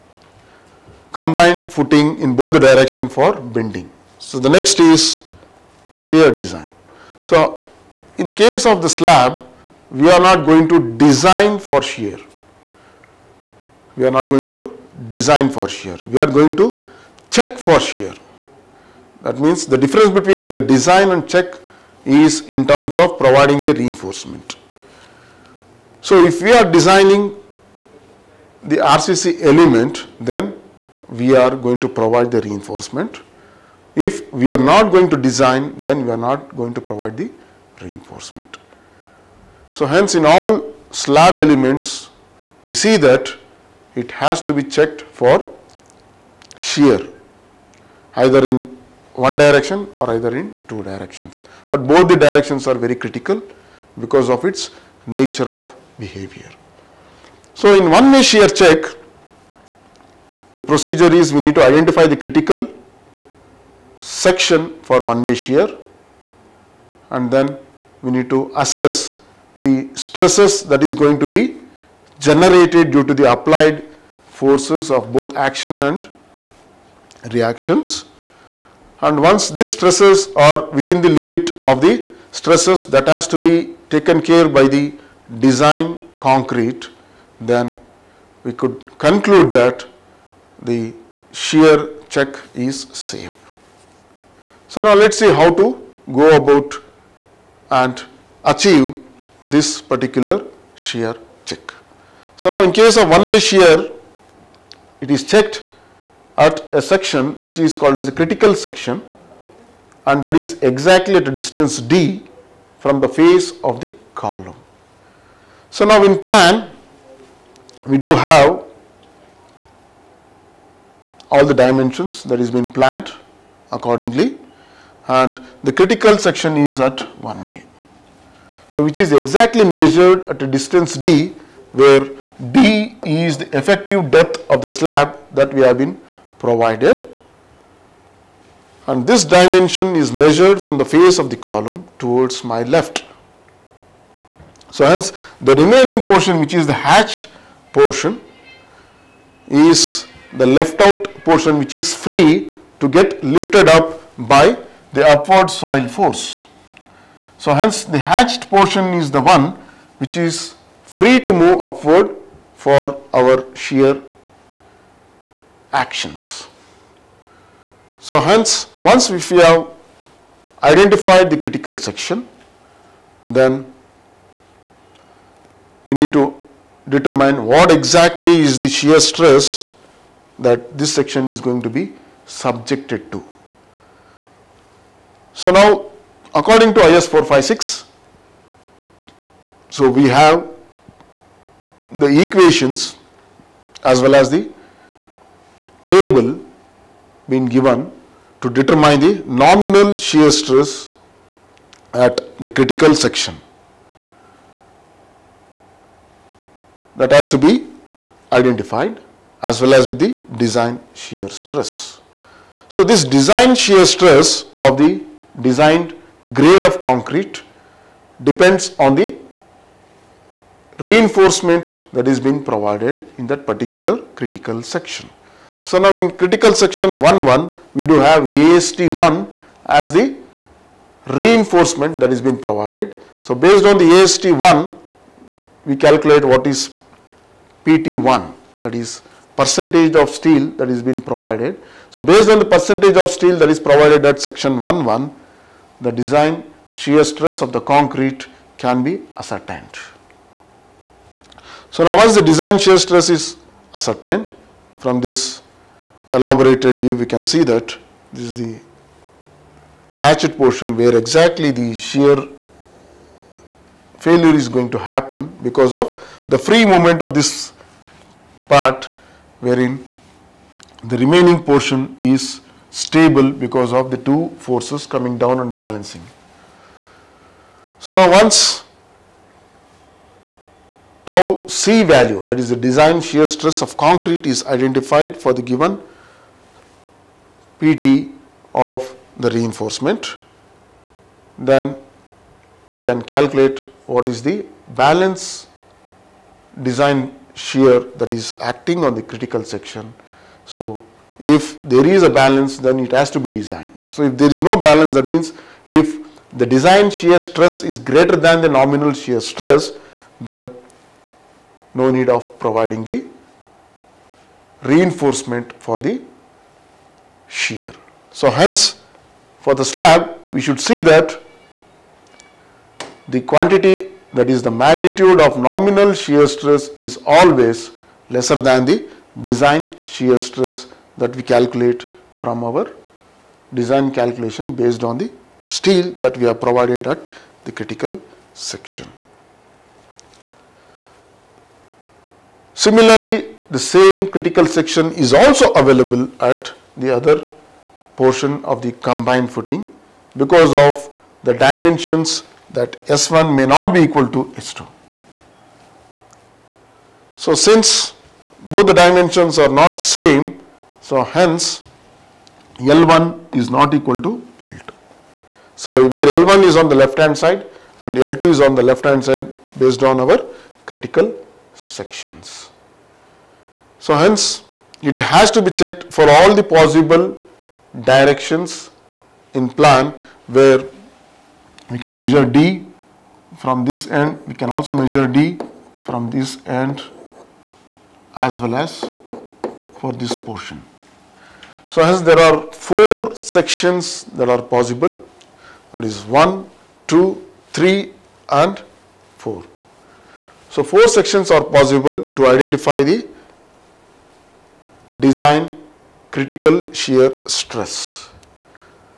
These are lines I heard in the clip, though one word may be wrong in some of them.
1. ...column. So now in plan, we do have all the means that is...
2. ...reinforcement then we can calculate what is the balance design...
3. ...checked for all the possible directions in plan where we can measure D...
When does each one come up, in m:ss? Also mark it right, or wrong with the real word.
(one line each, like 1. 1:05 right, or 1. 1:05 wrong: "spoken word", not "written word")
1. 1:54 wrong: "dimensions", not "means"
2. 4:49 right
3. 6:15 right.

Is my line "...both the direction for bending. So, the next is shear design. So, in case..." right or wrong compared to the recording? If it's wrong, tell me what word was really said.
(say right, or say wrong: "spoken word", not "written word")
right.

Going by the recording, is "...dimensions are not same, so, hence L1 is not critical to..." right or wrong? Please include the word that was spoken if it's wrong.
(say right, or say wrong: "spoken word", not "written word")
wrong: "equal", not "critical".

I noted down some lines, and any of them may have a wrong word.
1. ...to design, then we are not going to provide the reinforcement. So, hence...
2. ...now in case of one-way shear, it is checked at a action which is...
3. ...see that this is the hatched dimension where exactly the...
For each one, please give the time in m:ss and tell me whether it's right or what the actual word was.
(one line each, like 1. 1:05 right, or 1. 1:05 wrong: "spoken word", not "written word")
1. 0:35 right
2. 1:42 wrong: "section", not "action"
3. 4:17 wrong: "portion", not "dimension".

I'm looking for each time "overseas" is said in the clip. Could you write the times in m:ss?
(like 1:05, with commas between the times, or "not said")
not said.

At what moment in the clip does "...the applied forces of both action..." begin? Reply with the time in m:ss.
1:13.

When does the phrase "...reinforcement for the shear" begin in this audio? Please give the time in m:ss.
5:14.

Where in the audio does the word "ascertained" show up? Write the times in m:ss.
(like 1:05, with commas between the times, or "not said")
4:09, 4:13.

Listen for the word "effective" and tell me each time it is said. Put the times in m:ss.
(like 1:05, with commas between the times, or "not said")
2:13.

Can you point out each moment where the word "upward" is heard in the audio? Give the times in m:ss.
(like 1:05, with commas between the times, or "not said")
2:35, 2:41.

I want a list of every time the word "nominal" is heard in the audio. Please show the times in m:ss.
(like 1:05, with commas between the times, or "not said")
3:19, 5:08, 5:25.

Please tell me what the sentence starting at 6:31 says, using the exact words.
So hence there are four sections that are possible that is 1, 2, 3 and 4.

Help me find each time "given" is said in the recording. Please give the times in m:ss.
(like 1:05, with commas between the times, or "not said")
3:17, 4:45.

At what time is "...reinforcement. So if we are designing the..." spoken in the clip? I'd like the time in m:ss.
0:23.